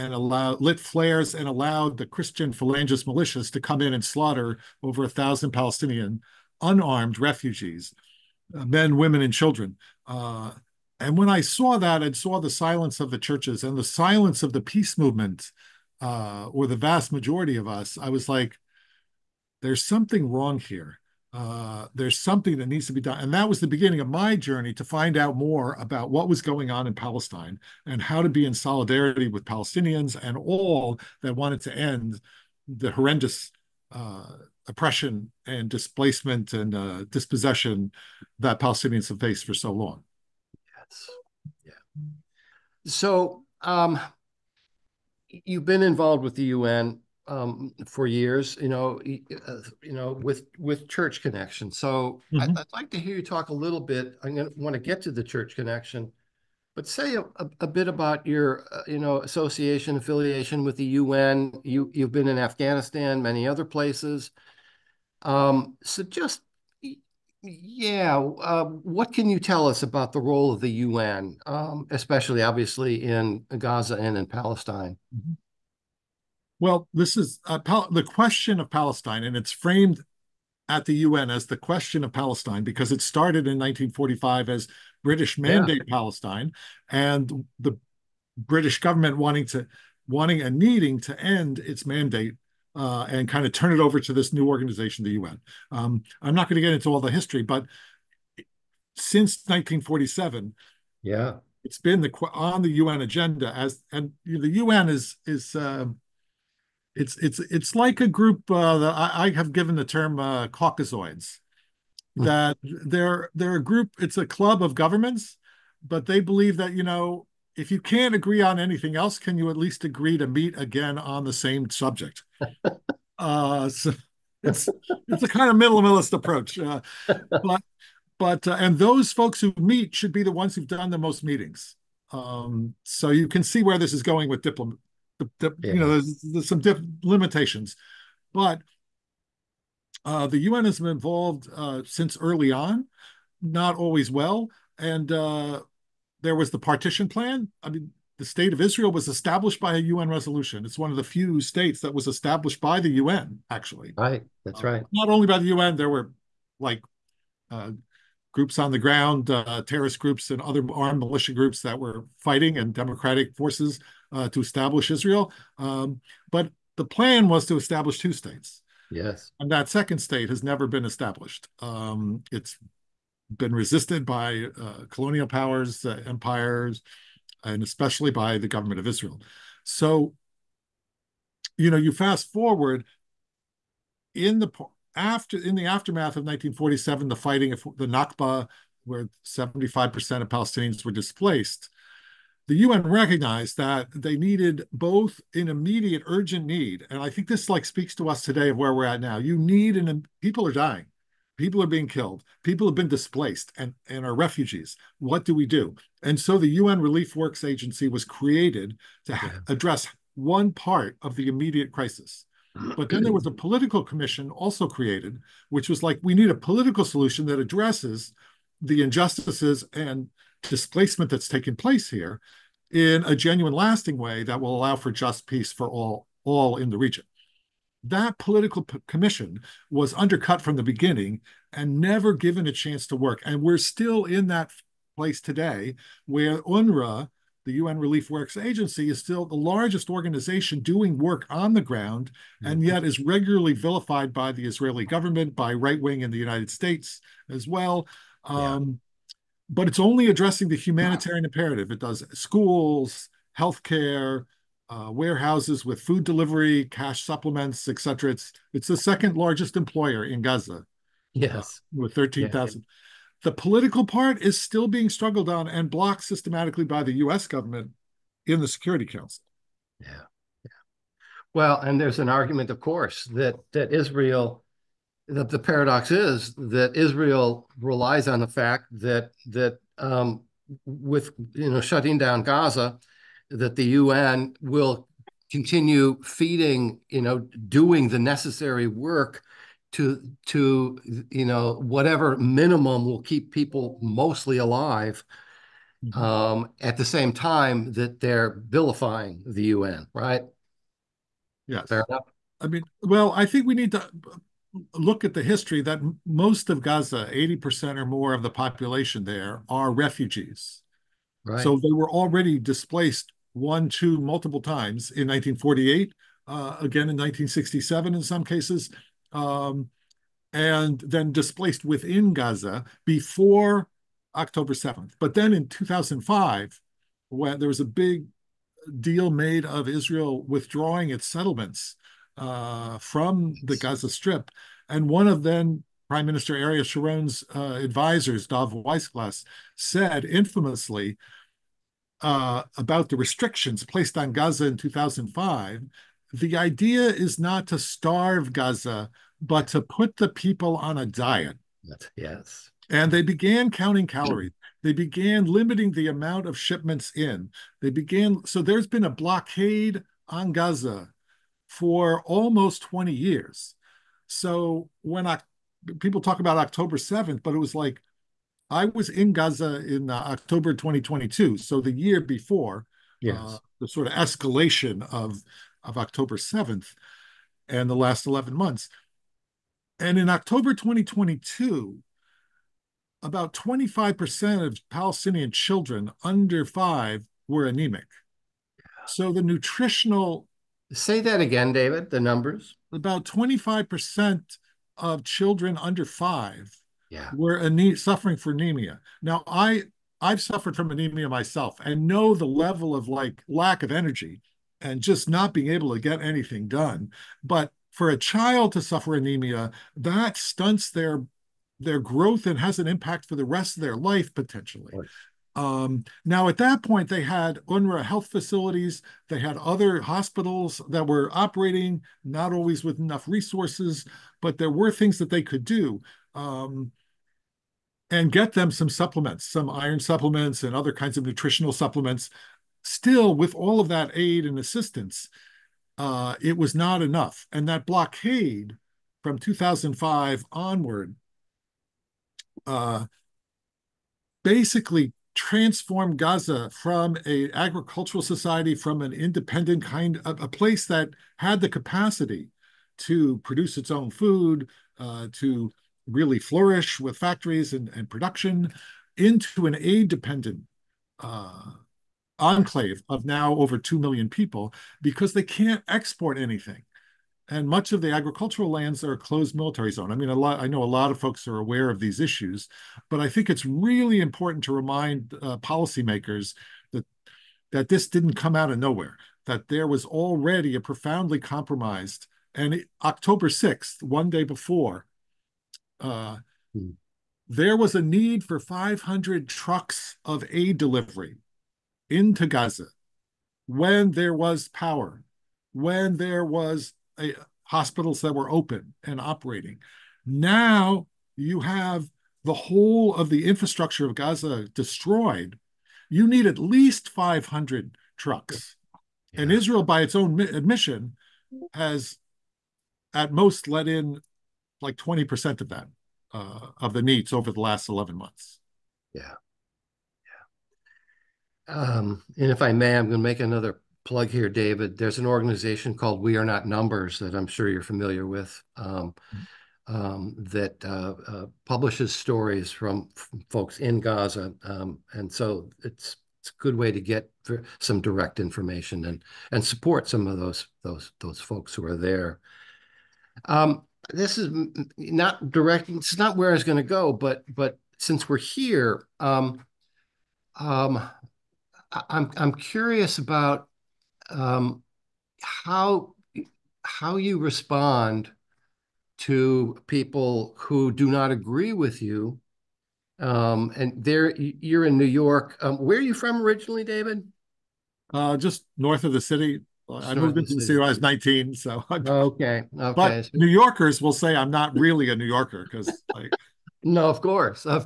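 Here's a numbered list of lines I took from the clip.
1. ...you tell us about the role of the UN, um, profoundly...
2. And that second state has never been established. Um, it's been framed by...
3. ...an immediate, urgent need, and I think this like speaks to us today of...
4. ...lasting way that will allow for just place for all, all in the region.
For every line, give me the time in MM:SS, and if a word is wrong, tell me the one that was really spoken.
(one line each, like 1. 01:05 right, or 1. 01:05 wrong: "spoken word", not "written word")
1. 01:09 wrong: "especially", not "profoundly"
2. 02:49 wrong: "resisted", not "framed"
3. 03:15 right
4. 03:43 wrong: "peace", not "place".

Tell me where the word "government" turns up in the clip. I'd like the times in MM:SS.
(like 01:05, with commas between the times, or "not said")
01:28, 01:54, 02:58, 04:04, 04:27.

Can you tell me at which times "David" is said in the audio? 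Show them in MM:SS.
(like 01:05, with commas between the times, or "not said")
06:31, 08:44, 09:26.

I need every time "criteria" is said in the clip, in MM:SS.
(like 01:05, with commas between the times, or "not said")
not said.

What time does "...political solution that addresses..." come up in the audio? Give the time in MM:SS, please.
03:36.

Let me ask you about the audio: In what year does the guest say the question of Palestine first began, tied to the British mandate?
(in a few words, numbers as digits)
1945.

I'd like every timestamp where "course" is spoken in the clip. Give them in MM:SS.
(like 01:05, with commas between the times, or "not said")
04:32, 09:36.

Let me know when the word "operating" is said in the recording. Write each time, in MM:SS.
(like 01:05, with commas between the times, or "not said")
07:01, 08:18.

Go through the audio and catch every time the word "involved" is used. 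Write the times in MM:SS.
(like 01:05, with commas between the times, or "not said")
00:45, 02:20.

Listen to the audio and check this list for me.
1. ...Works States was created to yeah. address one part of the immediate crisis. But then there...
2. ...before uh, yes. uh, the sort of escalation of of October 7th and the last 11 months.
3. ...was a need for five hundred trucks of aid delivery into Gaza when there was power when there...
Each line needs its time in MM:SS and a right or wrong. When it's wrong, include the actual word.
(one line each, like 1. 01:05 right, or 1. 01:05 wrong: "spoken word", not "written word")
1. 03:27 wrong: "Agency", not "States"
2. 06:11 right
3. 08:07 right.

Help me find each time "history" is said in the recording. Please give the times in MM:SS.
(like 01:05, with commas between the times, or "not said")
01:37, 05:05.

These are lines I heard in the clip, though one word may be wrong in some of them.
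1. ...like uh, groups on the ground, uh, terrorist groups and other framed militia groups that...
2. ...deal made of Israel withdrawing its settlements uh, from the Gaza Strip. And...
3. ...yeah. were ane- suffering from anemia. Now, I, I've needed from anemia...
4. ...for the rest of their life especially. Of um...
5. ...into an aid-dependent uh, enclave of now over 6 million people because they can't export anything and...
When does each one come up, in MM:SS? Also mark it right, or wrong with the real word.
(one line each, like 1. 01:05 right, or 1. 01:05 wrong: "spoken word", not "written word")
1. 02:36 wrong: "armed", not "framed"
2. 05:28 right
3. 06:36 wrong: "suffered", not "needed"
4. 06:53 wrong: "potentially", not "especially"
5. 07:38 wrong: "2", not "6".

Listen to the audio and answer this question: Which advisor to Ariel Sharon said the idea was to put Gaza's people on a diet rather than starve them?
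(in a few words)
Dov Weisglass.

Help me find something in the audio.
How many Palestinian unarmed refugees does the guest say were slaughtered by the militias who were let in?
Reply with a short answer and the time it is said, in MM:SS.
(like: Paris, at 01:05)
over a thousand, at 00:04.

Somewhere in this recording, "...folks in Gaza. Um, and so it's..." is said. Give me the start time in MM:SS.
08:53.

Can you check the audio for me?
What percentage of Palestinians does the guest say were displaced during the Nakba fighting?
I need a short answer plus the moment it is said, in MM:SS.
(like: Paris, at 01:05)
75%, at 03:09.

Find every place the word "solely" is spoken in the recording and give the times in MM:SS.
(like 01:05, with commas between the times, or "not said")
not said.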